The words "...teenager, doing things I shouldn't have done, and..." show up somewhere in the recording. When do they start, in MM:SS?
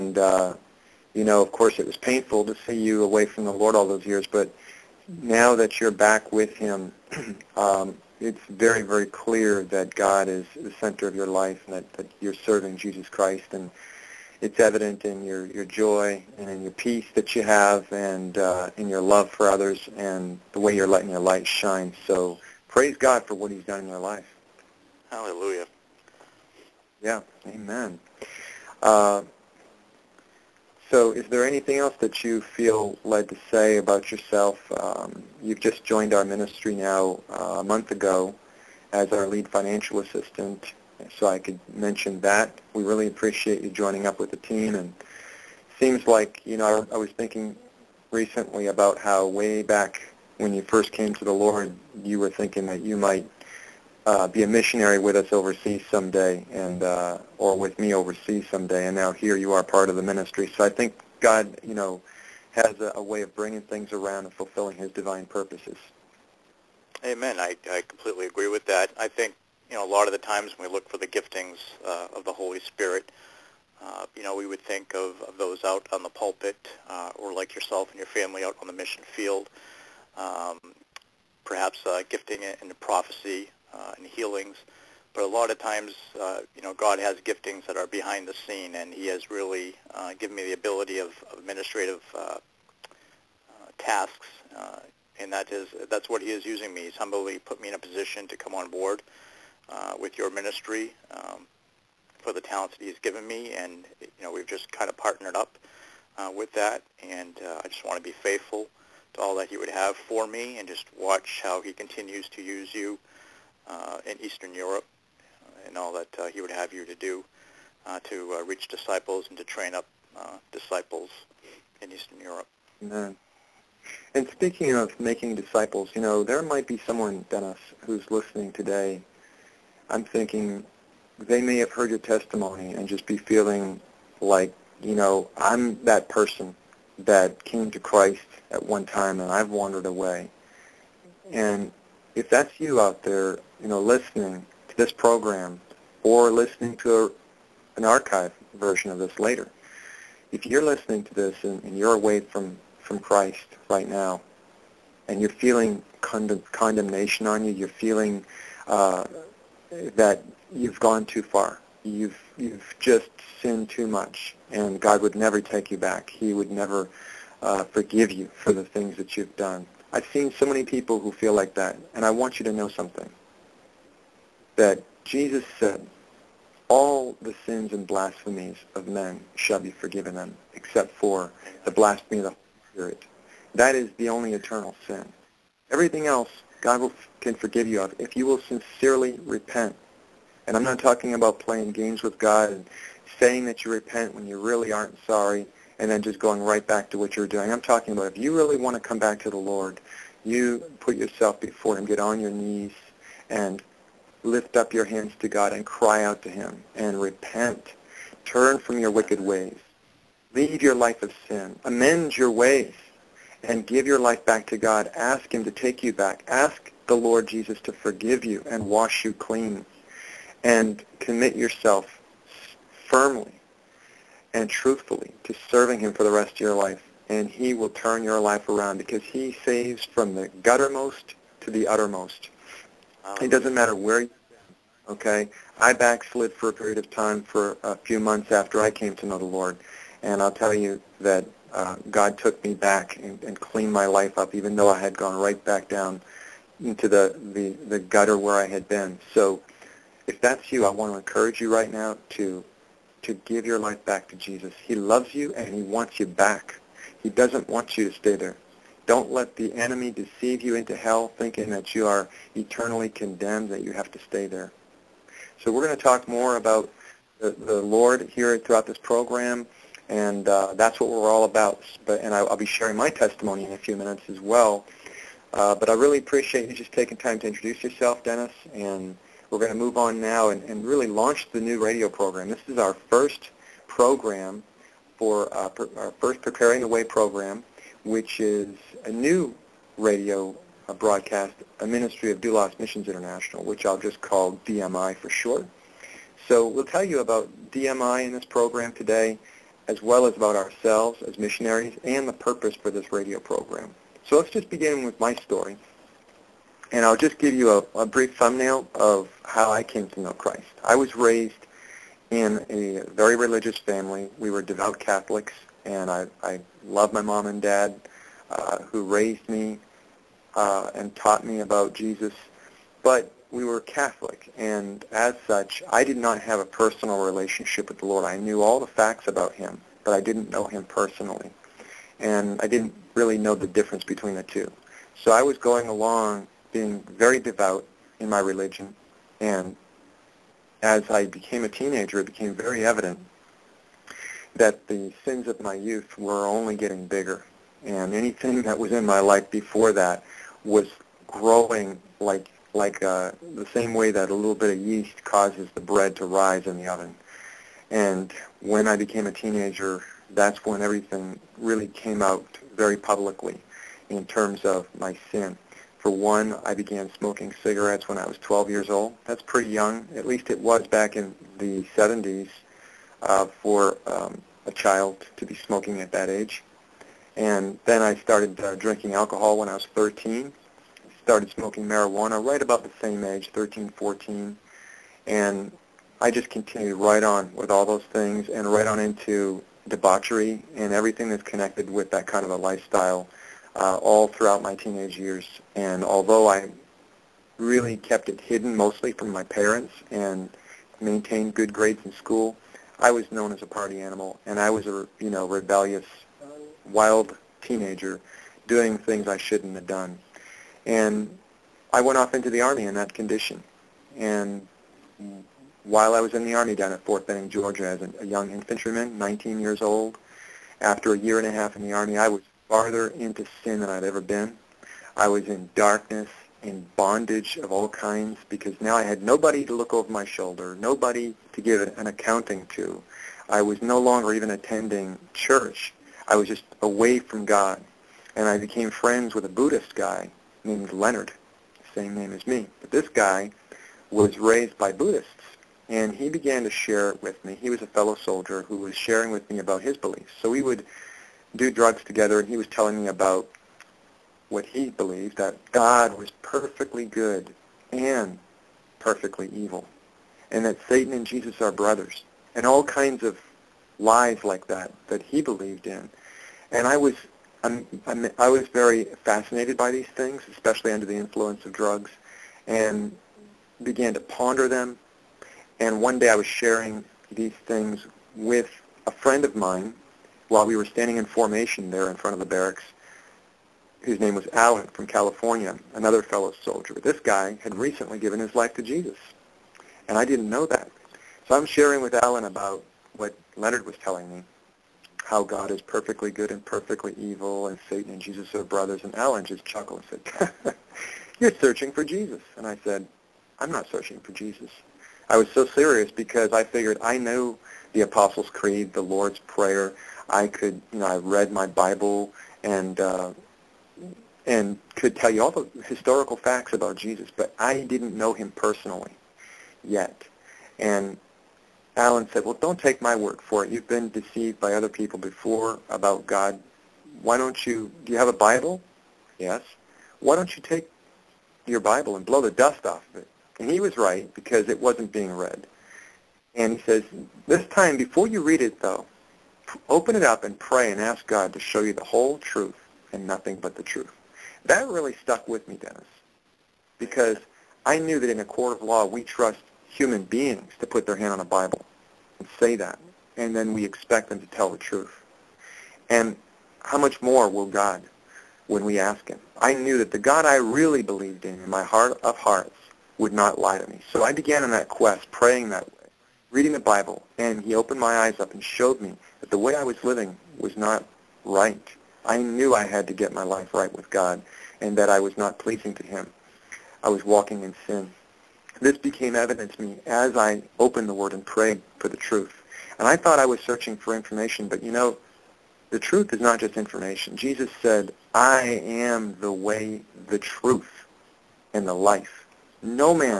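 06:47.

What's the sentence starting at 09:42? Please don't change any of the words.
And I thought I was searching for information, but you know, the truth is not just information.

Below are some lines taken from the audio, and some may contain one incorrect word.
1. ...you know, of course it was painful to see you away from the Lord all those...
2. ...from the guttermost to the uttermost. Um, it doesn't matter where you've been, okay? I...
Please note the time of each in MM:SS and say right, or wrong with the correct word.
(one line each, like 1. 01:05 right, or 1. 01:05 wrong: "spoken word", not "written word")
1. 00:01 right
2. 03:49 right.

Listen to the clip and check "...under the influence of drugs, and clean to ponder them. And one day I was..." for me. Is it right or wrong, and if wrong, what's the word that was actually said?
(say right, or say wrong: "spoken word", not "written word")
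wrong: "began", not "clean".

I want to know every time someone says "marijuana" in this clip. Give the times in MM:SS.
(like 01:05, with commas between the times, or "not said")
06:21.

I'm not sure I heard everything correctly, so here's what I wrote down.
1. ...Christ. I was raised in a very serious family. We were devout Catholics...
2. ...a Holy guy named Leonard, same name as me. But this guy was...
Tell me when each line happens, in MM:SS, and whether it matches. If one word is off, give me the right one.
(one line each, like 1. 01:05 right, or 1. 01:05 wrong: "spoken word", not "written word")
1. 05:10 wrong: "religious", not "serious"
2. 07:19 wrong: "Buddhist", not "Holy".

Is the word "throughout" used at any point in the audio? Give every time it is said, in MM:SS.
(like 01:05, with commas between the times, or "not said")
04:28, 06:34.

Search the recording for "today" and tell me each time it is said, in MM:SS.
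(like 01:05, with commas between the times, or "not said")
02:08, 04:58.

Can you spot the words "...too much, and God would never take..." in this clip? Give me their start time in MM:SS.
02:43.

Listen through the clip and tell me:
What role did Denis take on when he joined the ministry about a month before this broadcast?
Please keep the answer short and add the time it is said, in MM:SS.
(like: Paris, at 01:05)
lead financial assistant, at 00:39.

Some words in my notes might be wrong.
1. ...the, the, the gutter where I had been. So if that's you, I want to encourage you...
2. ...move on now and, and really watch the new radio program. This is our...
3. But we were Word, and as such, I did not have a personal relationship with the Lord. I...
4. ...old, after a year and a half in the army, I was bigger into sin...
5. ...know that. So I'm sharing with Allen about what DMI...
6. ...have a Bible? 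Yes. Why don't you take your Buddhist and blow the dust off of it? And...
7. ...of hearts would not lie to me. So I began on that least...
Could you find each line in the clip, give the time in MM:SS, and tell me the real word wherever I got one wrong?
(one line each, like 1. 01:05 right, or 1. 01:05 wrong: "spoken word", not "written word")
1. 04:06 right
2. 04:39 wrong: "launch", not "watch"
3. 05:22 wrong: "Catholic", not "Word"
4. 06:59 wrong: "farther", not "bigger"
5. 08:10 wrong: "Leonard", not "DMI"
6. 08:47 wrong: "Bible", not "Buddhist"
7. 09:22 wrong: "quest", not "least".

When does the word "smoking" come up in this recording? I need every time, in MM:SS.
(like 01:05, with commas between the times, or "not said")
06:06, 06:15, 06:21.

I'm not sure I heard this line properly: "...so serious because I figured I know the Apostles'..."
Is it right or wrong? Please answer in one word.
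right.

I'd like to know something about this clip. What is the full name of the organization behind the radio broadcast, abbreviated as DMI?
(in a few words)
Doulos Missions International.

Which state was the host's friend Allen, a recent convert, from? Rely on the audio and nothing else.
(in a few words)
California.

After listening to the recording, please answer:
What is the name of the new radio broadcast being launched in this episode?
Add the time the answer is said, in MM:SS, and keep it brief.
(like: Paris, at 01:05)
Preparing the Way, at 04:46.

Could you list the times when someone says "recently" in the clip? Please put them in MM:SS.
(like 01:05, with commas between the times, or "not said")
00:48, 08:07.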